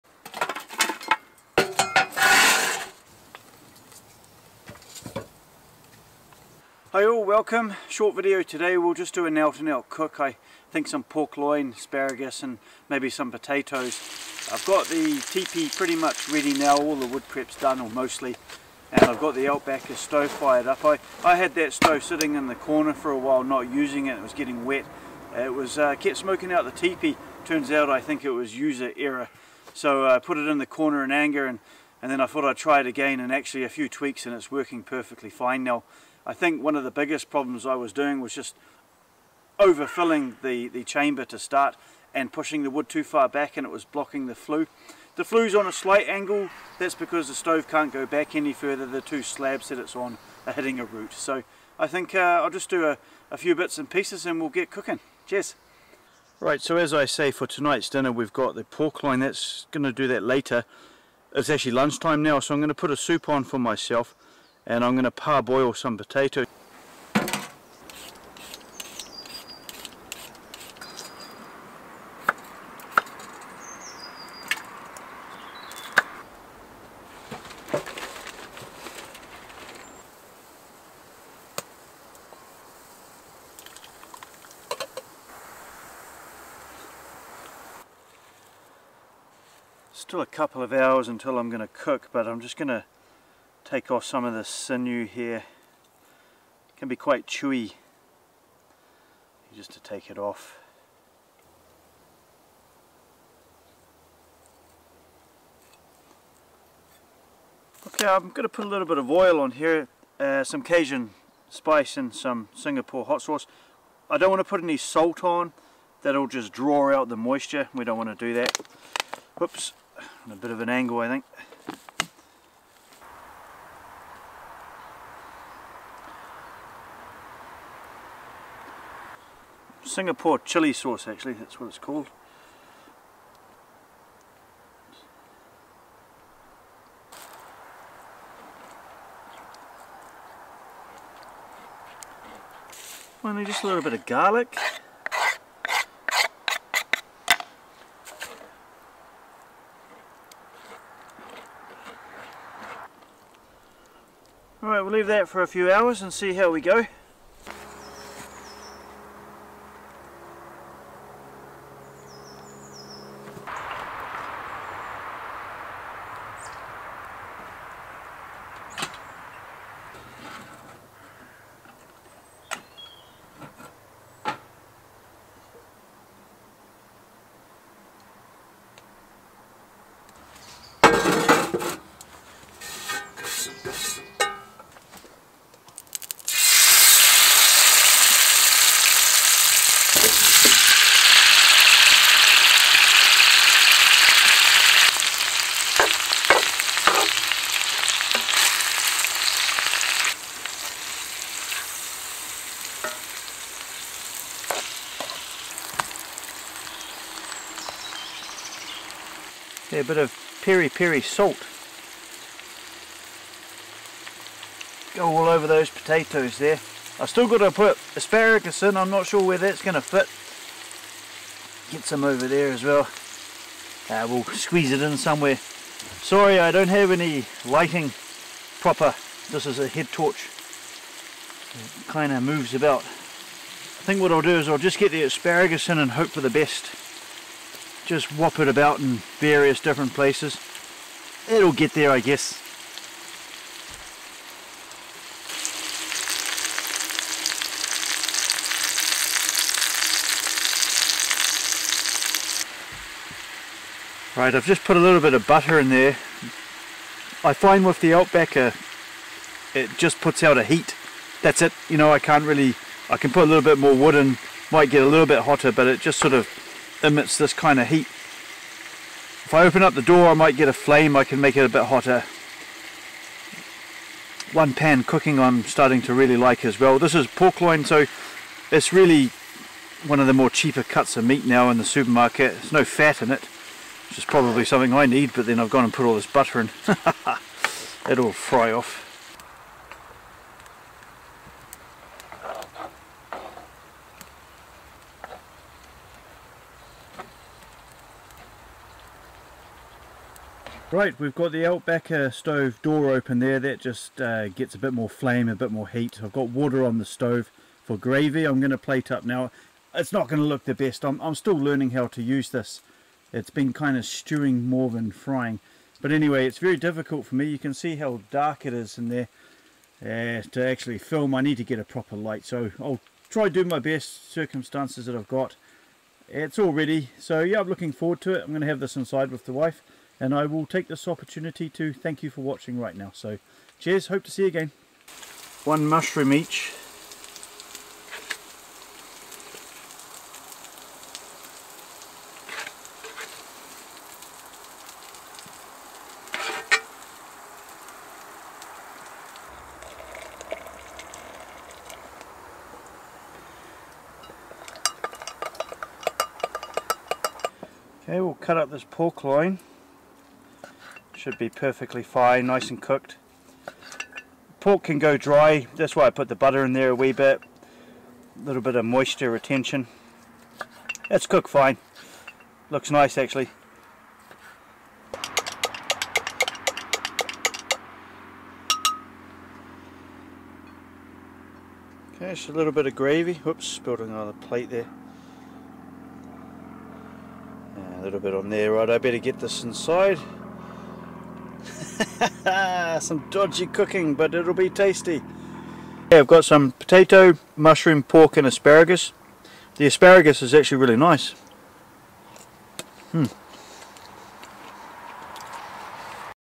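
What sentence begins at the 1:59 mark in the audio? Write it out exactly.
Oops, a bit of an angle I think.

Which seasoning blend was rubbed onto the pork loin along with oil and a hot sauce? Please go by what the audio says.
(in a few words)
Cajun spice.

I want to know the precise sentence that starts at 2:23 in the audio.
Only just a little bit of garlic.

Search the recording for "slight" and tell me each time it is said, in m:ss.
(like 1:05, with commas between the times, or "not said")
0:45.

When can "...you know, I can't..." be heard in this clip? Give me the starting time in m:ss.
4:21.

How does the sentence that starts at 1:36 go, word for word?
It can be quite chewy just to take it off.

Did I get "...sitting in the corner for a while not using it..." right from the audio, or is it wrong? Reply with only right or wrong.
right.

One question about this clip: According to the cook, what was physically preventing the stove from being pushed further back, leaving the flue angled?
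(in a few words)
A root.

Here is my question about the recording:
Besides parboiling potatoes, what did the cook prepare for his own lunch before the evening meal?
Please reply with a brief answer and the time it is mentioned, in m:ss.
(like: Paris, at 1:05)
Soup, at 1:02.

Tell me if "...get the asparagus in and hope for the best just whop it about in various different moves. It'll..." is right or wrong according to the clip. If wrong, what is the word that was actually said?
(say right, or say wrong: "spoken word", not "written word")
wrong: "places", not "moves".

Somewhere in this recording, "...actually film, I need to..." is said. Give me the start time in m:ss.
5:20.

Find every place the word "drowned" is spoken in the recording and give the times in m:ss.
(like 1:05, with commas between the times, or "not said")
not said.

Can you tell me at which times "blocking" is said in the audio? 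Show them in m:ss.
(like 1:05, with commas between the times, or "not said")
0:43.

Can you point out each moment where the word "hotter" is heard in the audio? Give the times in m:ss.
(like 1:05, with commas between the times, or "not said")
4:25, 4:31.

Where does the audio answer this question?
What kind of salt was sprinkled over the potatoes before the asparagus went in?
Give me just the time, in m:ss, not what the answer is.
3:30.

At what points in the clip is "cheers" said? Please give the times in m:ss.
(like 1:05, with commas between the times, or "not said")
0:55, 5:33.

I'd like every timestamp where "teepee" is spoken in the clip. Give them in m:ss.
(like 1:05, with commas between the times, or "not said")
0:15, 0:26.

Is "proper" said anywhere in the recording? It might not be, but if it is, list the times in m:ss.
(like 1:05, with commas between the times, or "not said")
3:48, 5:21.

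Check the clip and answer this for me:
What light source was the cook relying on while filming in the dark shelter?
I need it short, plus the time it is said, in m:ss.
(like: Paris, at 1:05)
A head torch, at 3:49.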